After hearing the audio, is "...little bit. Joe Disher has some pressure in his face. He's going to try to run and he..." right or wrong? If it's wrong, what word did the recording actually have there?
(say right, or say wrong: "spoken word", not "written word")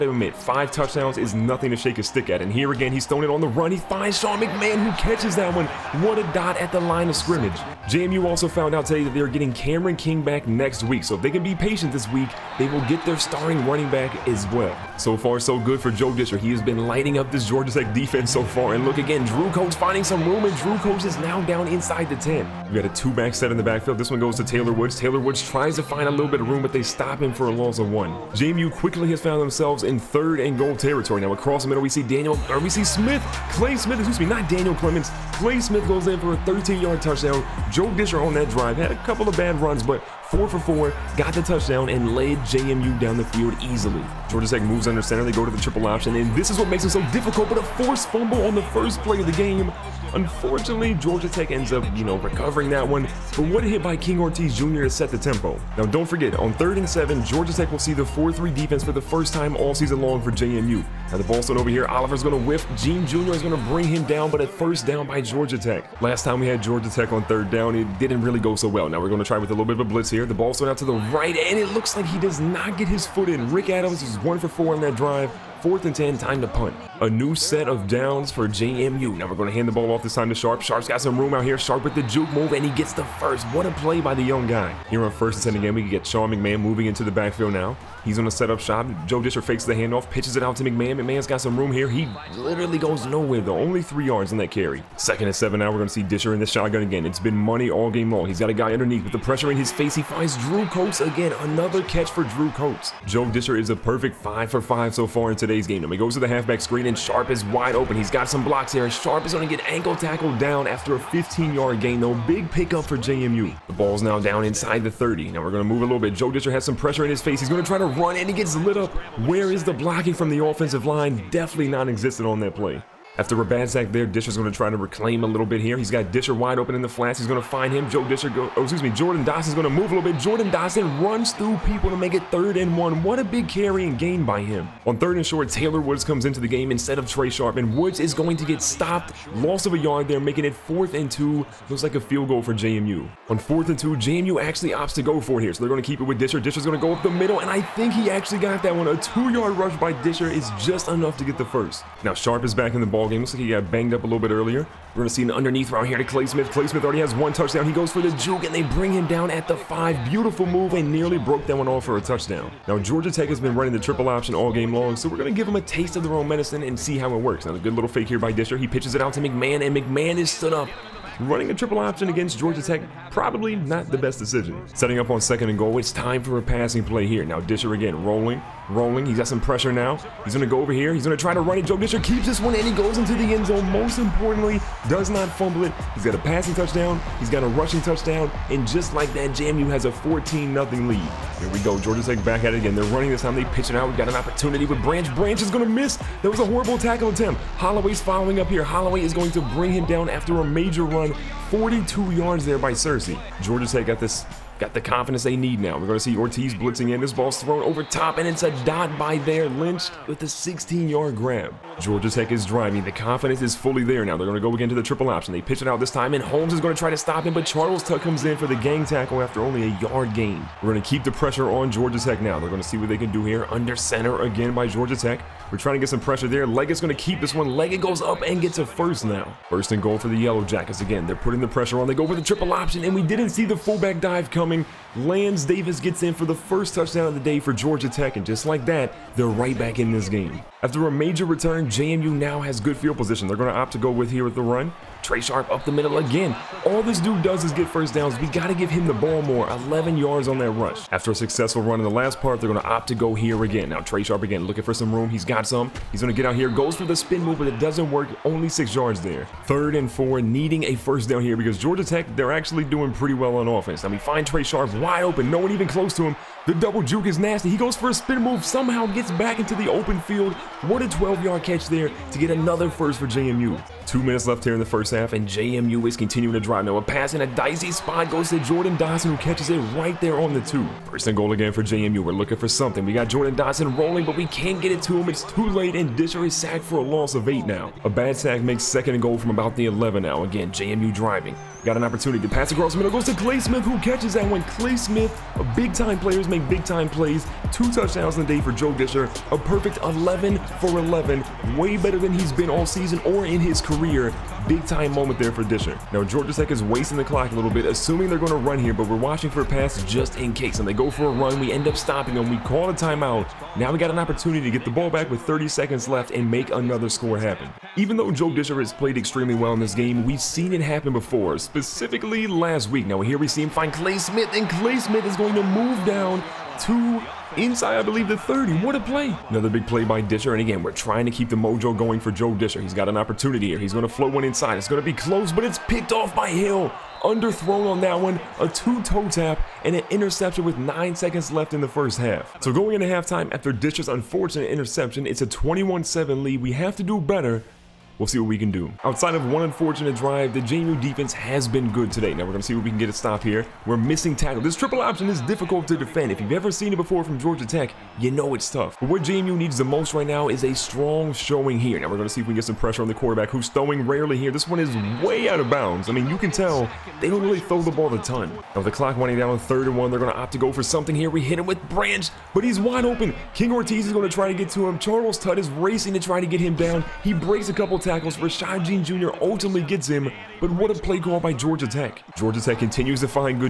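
right.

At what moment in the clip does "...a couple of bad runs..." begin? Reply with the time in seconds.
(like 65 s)
38 s.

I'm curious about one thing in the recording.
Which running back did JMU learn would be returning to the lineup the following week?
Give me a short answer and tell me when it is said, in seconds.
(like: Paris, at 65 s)
Cameron King, at 9 s.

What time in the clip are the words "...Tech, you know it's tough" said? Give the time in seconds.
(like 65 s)
357 s.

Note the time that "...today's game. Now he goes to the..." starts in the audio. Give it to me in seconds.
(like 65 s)
105 s.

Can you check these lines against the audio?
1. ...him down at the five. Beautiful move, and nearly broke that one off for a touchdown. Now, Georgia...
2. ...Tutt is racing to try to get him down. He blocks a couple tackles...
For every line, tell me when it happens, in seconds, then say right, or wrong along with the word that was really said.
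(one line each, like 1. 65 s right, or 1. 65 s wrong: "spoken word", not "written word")
1. 158 s right
2. 375 s wrong: "breaks", not "blocks".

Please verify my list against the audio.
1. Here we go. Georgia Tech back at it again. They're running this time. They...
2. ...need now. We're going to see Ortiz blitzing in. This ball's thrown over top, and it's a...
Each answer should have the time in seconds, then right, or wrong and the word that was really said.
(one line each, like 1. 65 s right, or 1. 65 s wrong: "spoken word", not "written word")
1. 191 s right
2. 205 s right.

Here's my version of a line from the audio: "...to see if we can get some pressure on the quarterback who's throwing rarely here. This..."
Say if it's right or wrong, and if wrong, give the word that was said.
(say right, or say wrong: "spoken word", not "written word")
right.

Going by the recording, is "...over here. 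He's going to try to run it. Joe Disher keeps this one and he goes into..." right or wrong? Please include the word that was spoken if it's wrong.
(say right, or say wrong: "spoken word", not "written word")
right.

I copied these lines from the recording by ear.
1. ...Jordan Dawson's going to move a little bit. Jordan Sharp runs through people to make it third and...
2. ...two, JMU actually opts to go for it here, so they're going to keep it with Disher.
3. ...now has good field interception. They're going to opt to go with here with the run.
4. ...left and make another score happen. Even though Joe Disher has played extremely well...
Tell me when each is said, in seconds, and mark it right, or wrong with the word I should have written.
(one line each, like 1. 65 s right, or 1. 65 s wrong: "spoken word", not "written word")
1. 128 s wrong: "Dawson", not "Sharp"
2. 143 s right
3. 242 s wrong: "position", not "interception"
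4. 315 s right.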